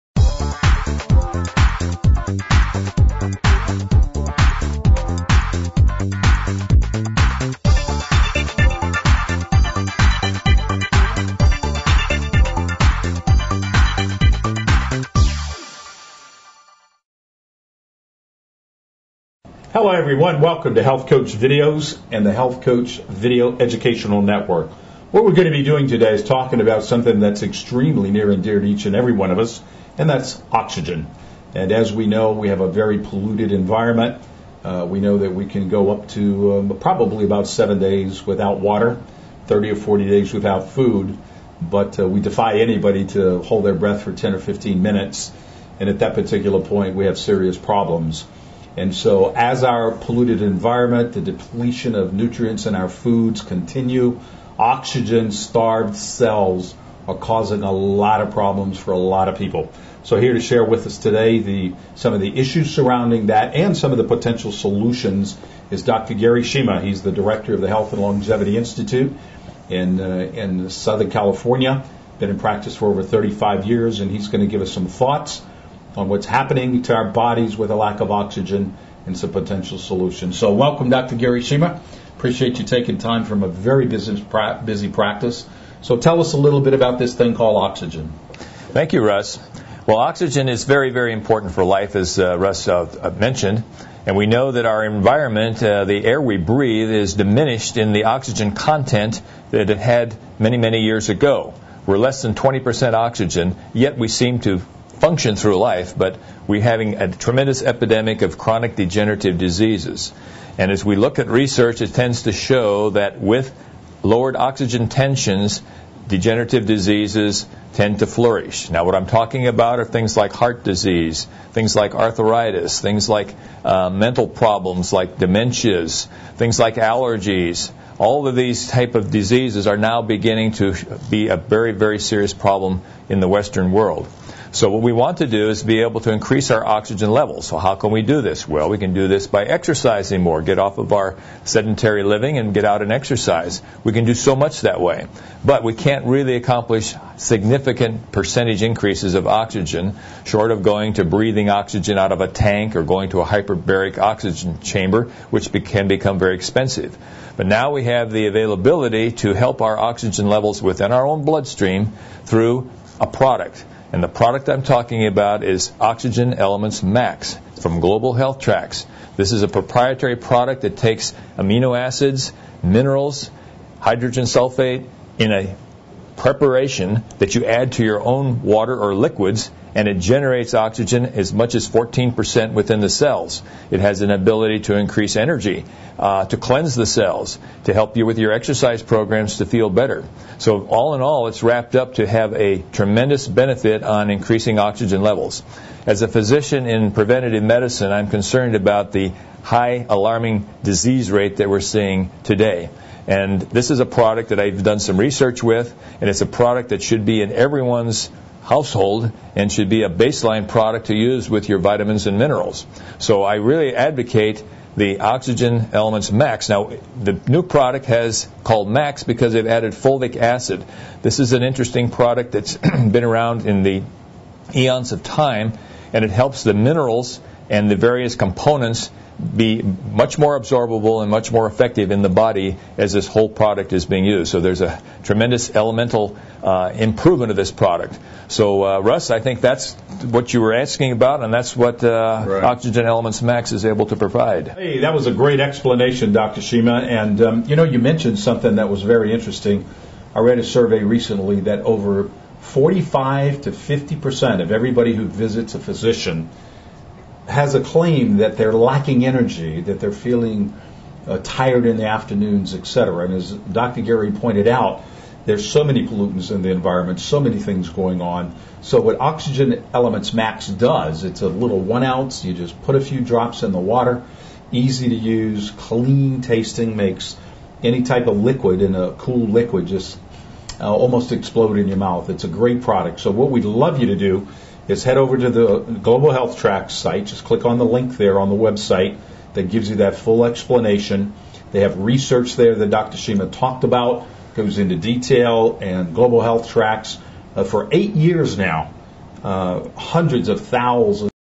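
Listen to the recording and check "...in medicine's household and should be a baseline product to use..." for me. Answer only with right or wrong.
wrong.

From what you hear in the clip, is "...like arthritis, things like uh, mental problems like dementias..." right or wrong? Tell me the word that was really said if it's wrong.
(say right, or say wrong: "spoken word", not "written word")
right.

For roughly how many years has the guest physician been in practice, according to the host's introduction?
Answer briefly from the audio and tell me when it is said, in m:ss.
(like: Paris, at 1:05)
Over 35 years, at 1:13.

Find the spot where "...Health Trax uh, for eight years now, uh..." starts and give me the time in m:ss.
4:56.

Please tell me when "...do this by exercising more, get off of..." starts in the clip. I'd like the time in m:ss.
2:18.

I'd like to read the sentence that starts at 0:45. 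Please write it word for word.
And at that particular point, we have serious problems.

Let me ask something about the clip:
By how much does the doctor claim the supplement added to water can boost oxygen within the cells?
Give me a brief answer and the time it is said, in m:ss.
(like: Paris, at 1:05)
14%, at 3:01.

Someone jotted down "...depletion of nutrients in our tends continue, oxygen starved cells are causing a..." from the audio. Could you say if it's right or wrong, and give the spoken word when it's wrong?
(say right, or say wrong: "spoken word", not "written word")
wrong: "foods", not "tends".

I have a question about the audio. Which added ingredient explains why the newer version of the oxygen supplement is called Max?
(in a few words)
Fulvic acid.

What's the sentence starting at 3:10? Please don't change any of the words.
So, all in all, it's wrapped up to have a tremendous benefit on increasing oxygen levels.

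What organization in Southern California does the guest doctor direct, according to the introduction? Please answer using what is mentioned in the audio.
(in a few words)
Health and Longevity Institute.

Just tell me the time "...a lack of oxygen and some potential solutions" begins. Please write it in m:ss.
1:17.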